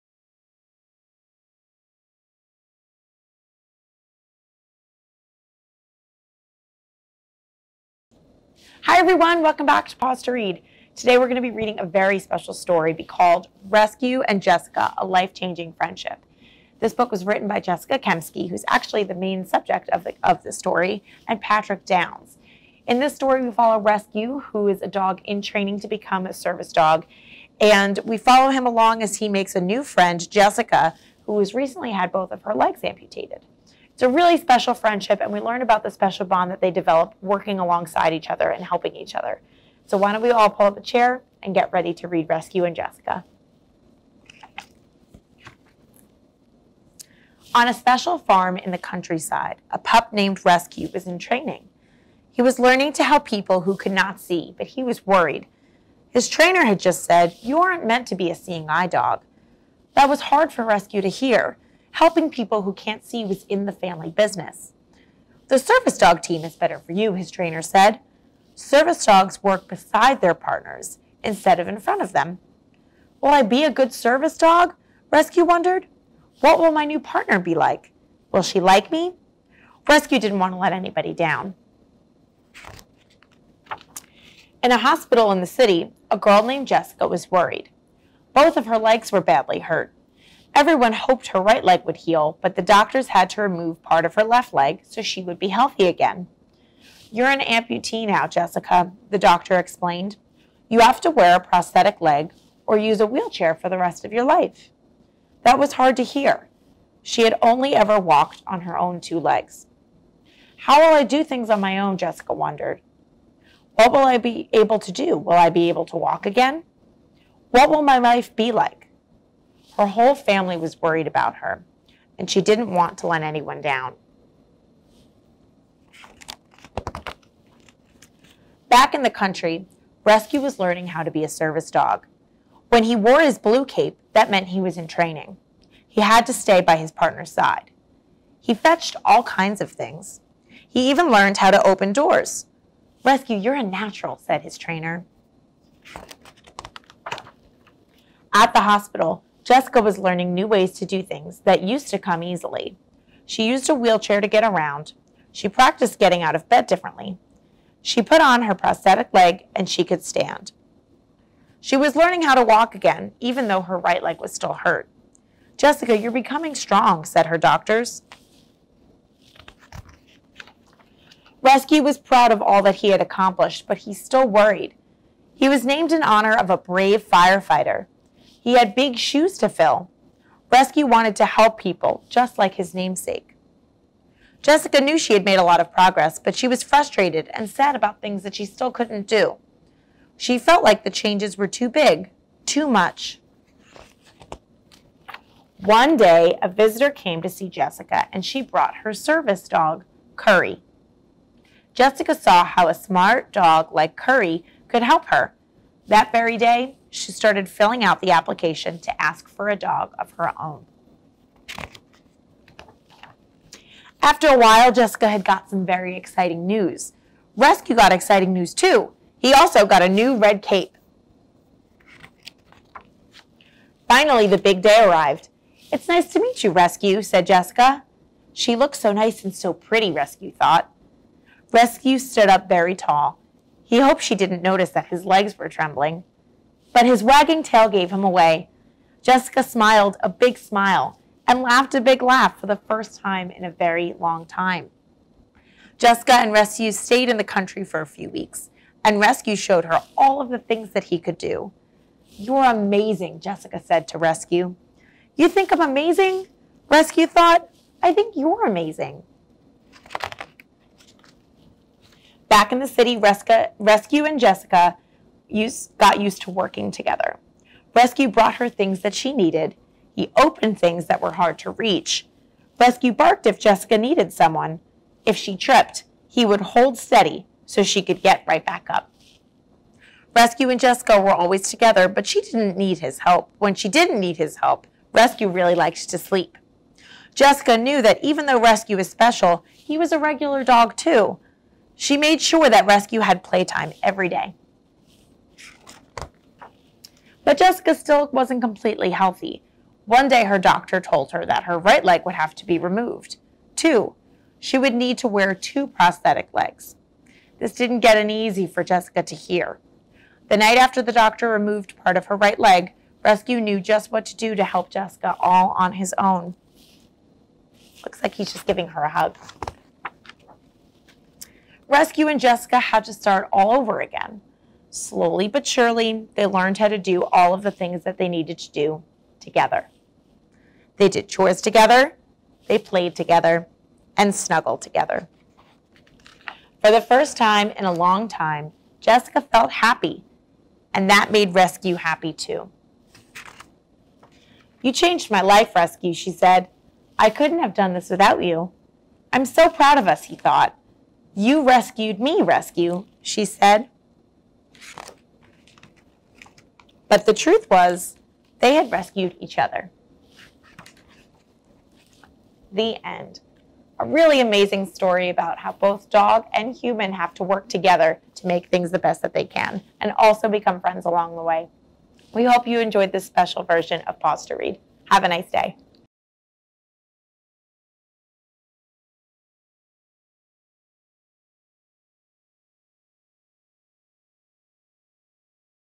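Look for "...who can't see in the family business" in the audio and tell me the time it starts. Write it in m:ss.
1:02.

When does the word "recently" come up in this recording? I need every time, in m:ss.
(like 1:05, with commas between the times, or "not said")
0:31.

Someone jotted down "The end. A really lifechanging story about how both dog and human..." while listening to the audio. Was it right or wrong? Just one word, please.
wrong.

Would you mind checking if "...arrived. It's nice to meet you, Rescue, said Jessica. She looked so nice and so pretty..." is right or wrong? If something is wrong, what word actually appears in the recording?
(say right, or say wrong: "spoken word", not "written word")
right.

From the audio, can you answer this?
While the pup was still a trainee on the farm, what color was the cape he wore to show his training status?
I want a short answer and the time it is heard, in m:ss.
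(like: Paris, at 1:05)
Blue, at 2:13.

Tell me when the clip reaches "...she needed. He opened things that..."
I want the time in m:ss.
4:28.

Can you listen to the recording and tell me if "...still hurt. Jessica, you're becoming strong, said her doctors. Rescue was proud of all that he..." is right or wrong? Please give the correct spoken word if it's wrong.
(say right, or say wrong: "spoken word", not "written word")
right.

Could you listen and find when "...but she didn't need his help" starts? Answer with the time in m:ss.
4:41.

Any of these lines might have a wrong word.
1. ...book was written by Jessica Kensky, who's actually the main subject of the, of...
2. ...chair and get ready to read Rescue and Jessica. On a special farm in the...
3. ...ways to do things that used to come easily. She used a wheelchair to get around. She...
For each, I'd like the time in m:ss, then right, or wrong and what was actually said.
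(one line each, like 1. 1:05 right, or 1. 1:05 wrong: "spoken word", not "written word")
1. 0:16 right
2. 0:40 right
3. 2:30 right.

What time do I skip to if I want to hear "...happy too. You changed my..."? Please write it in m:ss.
5:41.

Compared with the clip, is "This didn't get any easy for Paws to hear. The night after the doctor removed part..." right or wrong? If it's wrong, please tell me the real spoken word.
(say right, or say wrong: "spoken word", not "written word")
wrong: "Jessica", not "Paws".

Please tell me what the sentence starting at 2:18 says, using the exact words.
He fetched all kinds of things.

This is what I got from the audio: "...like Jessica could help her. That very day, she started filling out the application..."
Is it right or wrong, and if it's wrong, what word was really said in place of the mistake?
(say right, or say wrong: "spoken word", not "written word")
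wrong: "Curry", not "Jessica".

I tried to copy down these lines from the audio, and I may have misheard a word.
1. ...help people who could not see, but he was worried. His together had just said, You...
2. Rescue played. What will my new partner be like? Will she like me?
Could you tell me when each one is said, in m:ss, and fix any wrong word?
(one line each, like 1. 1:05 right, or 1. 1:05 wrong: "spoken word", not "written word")
1. 0:53 wrong: "trainer", not "together"
2. 1:15 wrong: "wondered", not "played".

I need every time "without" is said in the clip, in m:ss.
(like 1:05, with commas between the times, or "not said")
5:47.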